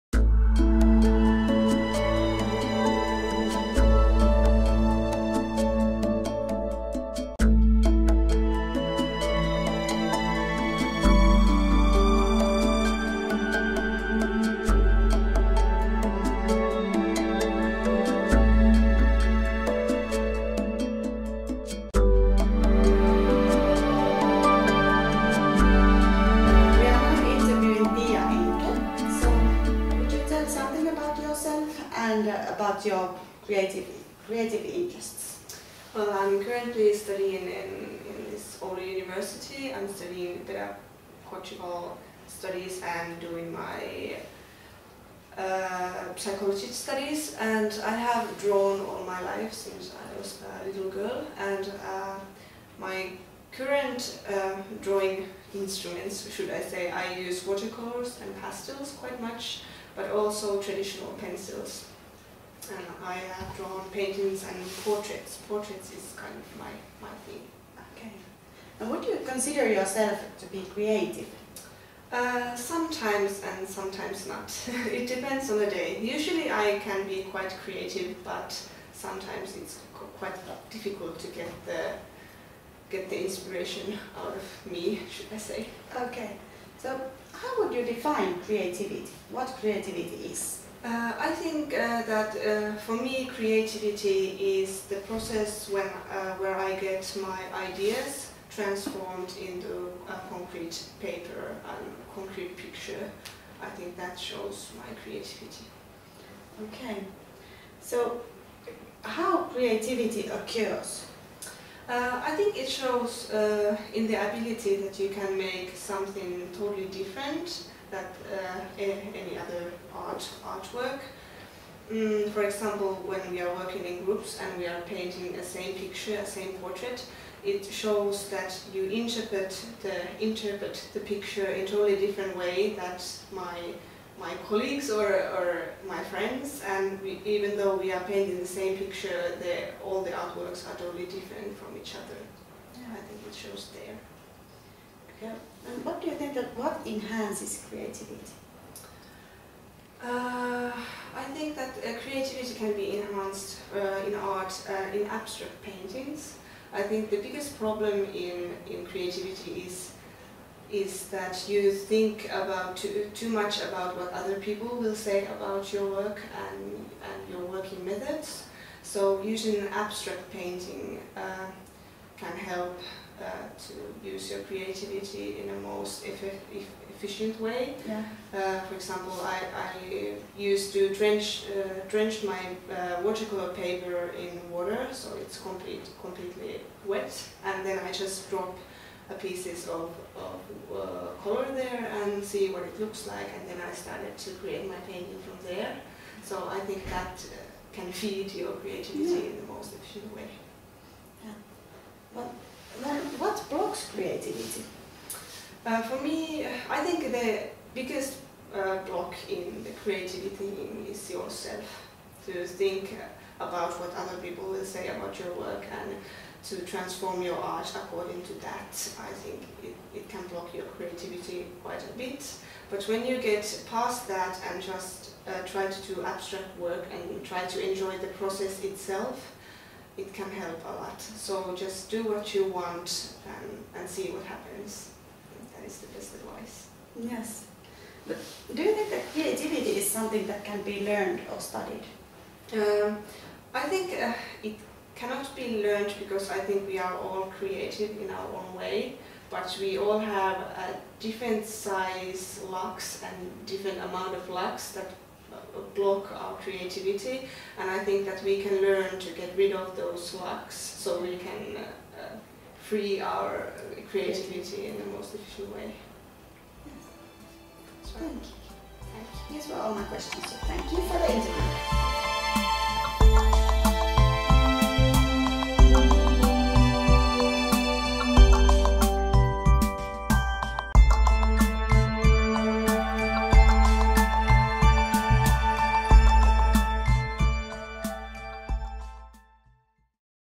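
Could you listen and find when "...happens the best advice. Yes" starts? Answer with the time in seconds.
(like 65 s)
234 s.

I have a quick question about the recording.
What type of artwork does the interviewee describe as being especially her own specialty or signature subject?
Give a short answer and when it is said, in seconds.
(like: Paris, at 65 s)
Portraits, at 65 s.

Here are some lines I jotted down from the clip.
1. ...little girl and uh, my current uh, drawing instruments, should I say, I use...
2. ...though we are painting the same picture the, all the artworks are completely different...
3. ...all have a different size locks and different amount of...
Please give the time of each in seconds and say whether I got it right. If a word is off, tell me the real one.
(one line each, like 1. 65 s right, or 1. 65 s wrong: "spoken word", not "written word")
1. 50 s right
2. 137 s wrong: "totally", not "completely"
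3. 249 s right.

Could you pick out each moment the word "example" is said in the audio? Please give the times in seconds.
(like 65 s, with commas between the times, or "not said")
122 s, 178 s.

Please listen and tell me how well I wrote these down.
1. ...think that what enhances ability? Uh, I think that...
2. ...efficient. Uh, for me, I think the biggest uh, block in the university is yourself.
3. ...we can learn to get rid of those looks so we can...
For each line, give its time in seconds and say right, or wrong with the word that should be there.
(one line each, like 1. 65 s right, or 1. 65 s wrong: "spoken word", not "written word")
1. 146 s wrong: "creativity", not "ability"
2. 199 s wrong: "creativity", not "university"
3. 258 s wrong: "locks", not "looks".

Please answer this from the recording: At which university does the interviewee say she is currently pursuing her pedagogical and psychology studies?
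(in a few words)
Oulu university.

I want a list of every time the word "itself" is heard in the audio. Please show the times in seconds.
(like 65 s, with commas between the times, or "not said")
228 s.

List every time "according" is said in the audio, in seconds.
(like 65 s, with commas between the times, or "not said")
217 s.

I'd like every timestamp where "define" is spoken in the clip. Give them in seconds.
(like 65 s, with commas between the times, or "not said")
87 s.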